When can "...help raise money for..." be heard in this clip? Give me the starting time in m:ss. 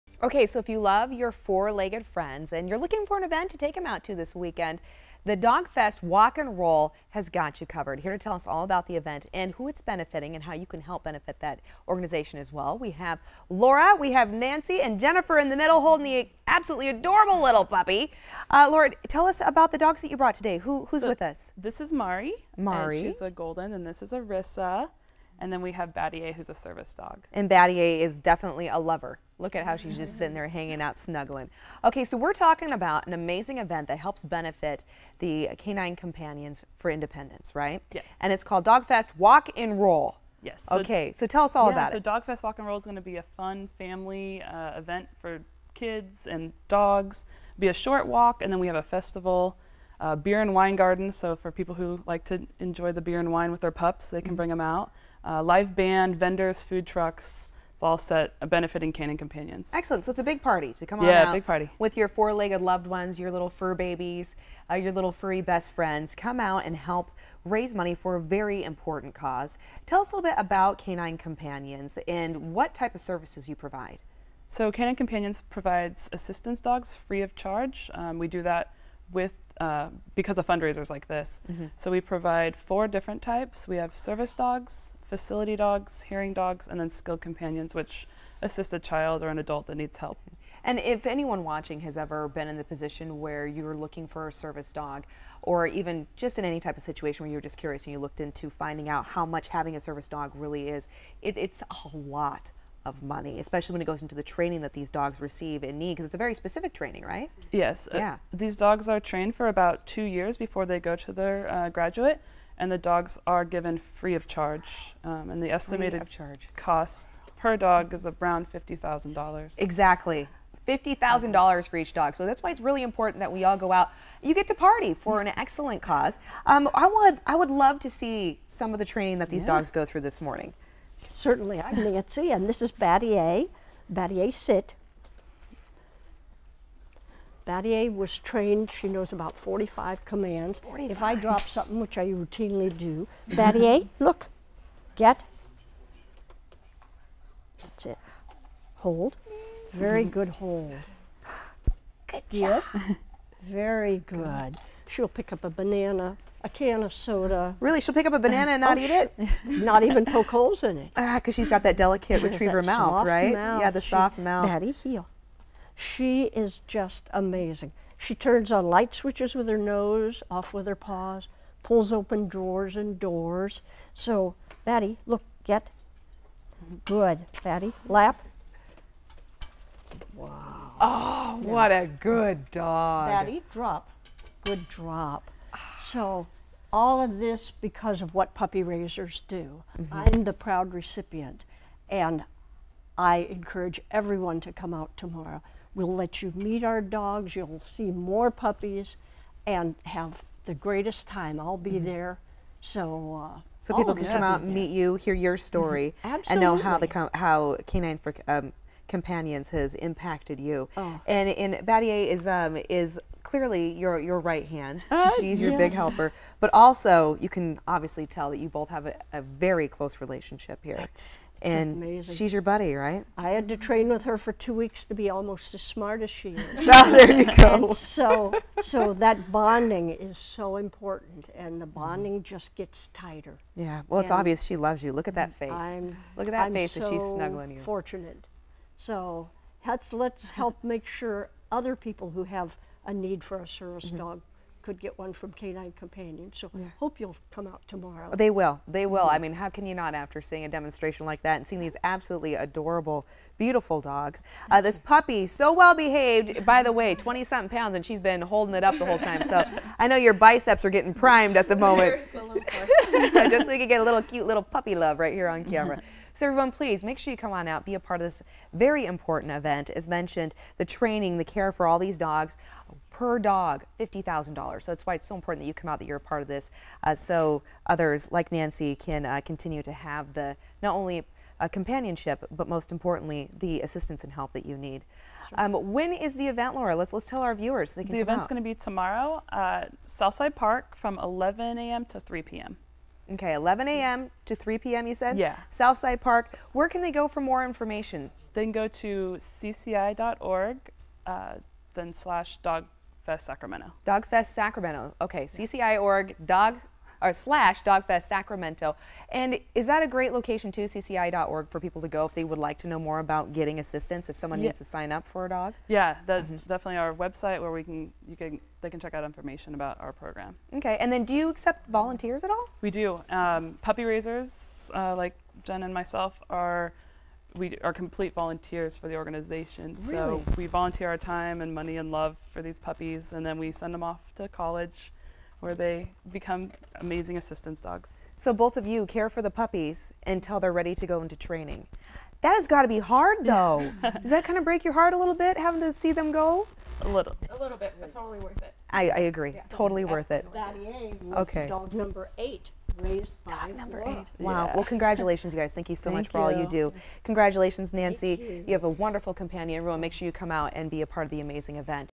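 1:06.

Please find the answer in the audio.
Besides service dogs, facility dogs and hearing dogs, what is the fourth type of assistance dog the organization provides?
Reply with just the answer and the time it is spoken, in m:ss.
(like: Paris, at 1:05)
Skilled companions, at 1:26.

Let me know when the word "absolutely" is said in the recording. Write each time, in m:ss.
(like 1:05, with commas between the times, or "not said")
0:16, 4:11.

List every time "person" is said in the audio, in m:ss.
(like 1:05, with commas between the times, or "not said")
not said.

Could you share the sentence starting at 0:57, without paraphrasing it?
It's all set uh, benefiting Canine Companions.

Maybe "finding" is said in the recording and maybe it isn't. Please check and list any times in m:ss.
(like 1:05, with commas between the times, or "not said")
1:38.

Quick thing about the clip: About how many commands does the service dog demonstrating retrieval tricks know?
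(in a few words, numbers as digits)
45.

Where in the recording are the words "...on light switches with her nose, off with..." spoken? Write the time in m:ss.
2:48.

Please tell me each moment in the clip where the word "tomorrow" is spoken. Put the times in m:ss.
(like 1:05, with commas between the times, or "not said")
3:14, 4:07, 4:48.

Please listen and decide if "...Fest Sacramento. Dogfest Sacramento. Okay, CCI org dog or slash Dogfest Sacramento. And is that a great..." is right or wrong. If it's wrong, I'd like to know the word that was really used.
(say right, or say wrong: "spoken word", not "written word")
right.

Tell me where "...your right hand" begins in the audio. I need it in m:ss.
3:33.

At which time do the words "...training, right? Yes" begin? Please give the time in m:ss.
1:46.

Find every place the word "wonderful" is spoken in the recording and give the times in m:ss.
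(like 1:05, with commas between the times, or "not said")
5:58.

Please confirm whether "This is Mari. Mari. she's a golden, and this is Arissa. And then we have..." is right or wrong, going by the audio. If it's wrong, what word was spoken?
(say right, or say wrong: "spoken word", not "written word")
right.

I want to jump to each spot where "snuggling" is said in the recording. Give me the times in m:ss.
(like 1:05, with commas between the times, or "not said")
0:30, 3:57.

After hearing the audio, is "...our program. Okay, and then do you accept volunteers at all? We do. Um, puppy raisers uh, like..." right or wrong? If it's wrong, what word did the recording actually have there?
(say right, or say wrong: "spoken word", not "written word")
right.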